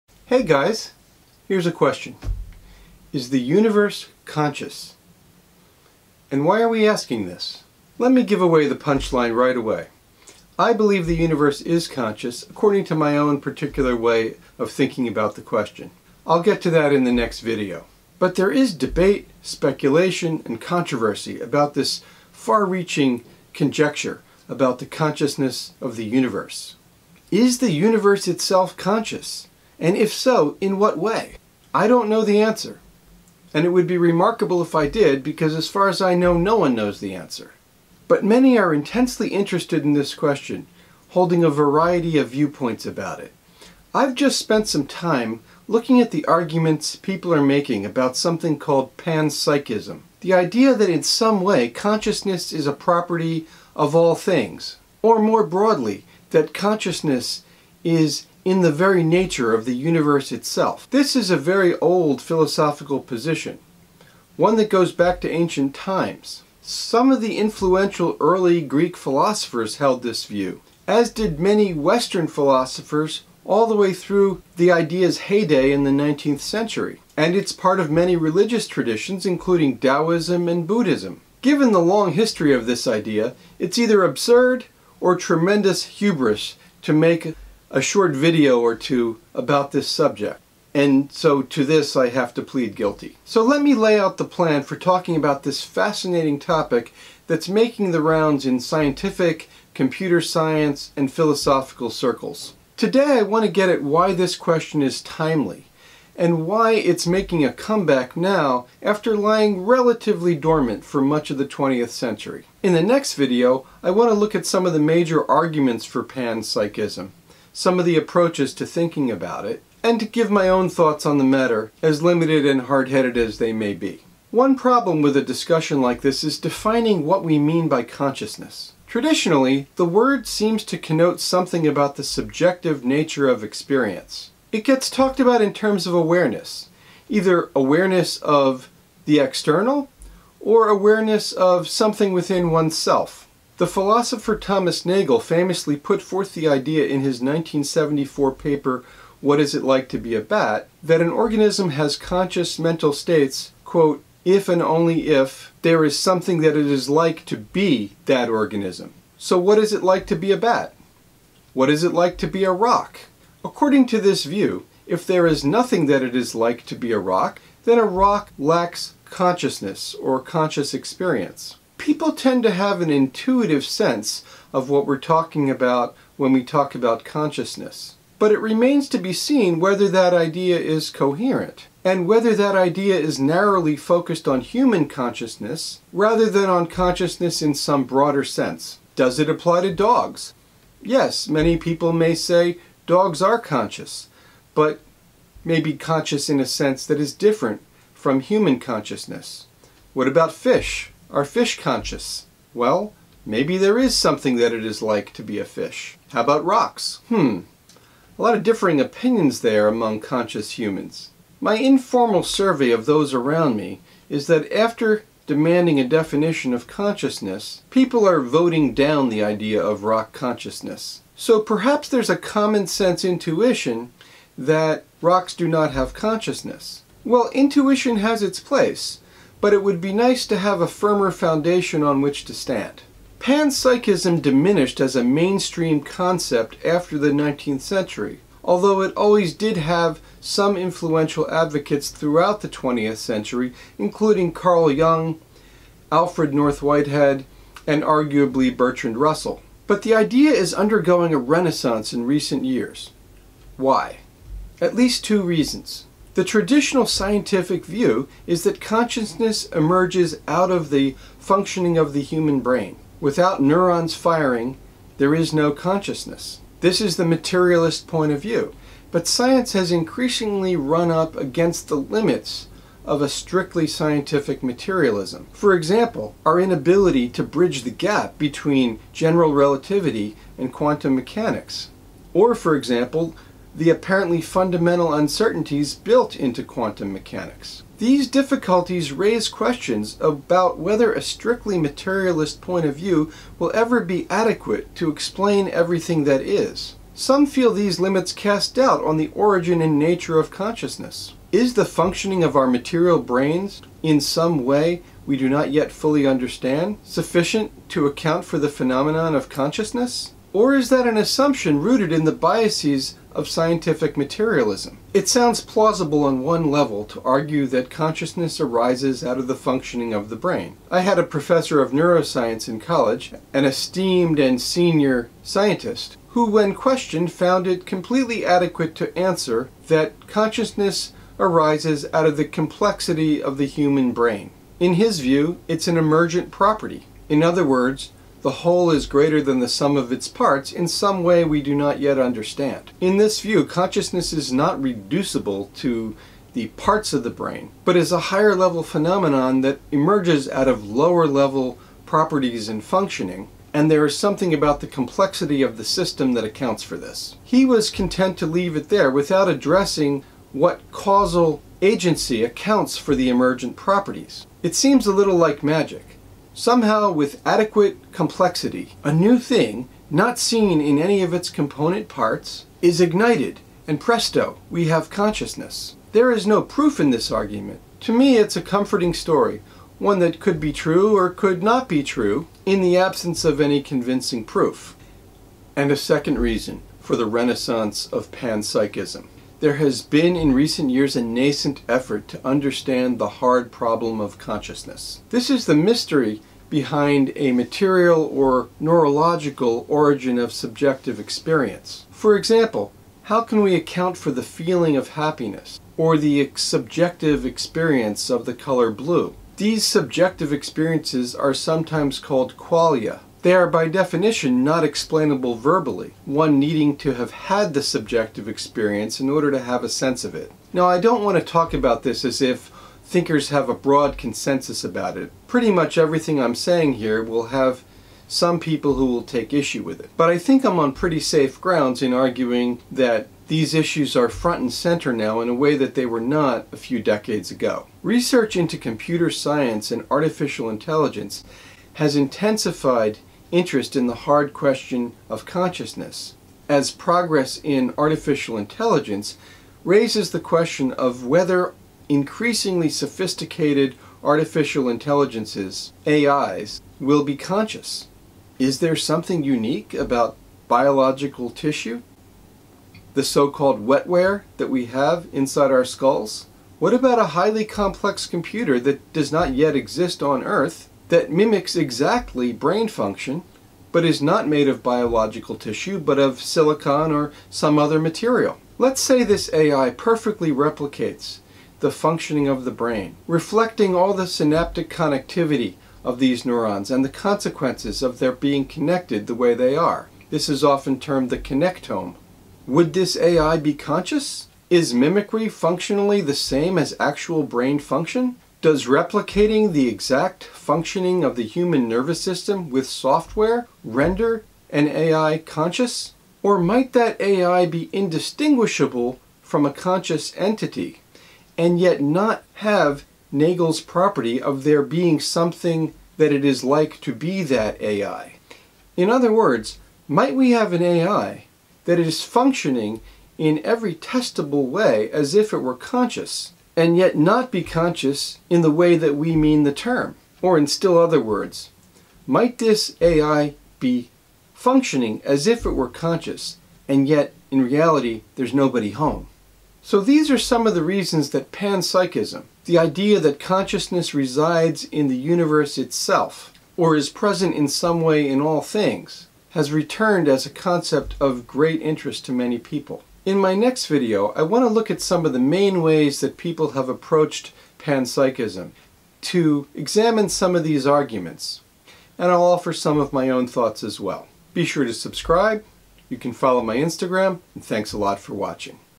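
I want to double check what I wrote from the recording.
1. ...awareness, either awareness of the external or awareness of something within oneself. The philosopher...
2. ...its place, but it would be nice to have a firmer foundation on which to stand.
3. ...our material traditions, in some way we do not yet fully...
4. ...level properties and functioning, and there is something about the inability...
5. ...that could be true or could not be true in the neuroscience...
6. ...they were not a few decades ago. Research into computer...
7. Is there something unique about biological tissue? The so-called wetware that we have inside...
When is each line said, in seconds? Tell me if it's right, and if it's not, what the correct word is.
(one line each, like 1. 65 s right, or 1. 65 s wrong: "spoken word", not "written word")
1. 135 s right
2. 228 s right
3. 302 s wrong: "brains", not "traditions"
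4. 351 s wrong: "complexity", not "inability"
5. 379 s wrong: "absence", not "neuroscience"
6. 435 s right
7. 458 s right.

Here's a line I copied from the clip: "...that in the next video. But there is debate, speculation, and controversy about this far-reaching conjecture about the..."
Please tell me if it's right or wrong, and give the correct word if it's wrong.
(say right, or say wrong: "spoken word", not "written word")
right.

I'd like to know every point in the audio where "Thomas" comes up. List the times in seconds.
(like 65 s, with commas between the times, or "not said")
144 s.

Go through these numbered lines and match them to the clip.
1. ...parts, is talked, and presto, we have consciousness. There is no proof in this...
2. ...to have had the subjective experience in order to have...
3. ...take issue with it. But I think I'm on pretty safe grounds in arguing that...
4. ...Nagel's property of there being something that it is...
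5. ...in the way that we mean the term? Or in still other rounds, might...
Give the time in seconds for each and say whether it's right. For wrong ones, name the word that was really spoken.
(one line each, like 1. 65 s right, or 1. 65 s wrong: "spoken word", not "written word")
1. 371 s wrong: "ignited", not "talked"
2. 416 s right
3. 429 s right
4. 513 s right
5. 528 s wrong: "words", not "rounds".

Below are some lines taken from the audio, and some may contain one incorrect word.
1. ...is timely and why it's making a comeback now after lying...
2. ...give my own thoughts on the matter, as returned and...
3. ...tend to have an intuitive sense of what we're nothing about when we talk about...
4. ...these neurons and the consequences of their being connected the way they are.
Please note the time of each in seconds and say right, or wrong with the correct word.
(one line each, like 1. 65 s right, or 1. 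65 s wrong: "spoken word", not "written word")
1. 104 s right
2. 120 s wrong: "limited", not "returned"
3. 172 s wrong: "talking", not "nothing"
4. 485 s right.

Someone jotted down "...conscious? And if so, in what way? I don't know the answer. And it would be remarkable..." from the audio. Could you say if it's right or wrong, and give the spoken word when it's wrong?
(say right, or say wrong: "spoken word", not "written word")
right.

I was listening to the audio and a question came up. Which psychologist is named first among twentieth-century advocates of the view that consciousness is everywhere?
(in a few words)
Carl Jung.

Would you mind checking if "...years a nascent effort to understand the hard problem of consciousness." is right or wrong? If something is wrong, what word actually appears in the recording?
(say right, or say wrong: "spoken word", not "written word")
right.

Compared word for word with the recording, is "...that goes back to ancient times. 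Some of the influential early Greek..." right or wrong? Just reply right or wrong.
right.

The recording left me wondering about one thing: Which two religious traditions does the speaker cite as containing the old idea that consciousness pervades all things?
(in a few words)
Taoism and Buddhism.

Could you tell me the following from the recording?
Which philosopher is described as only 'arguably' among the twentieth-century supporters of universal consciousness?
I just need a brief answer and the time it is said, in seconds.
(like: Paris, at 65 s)
Bertrand Russell, at 248 s.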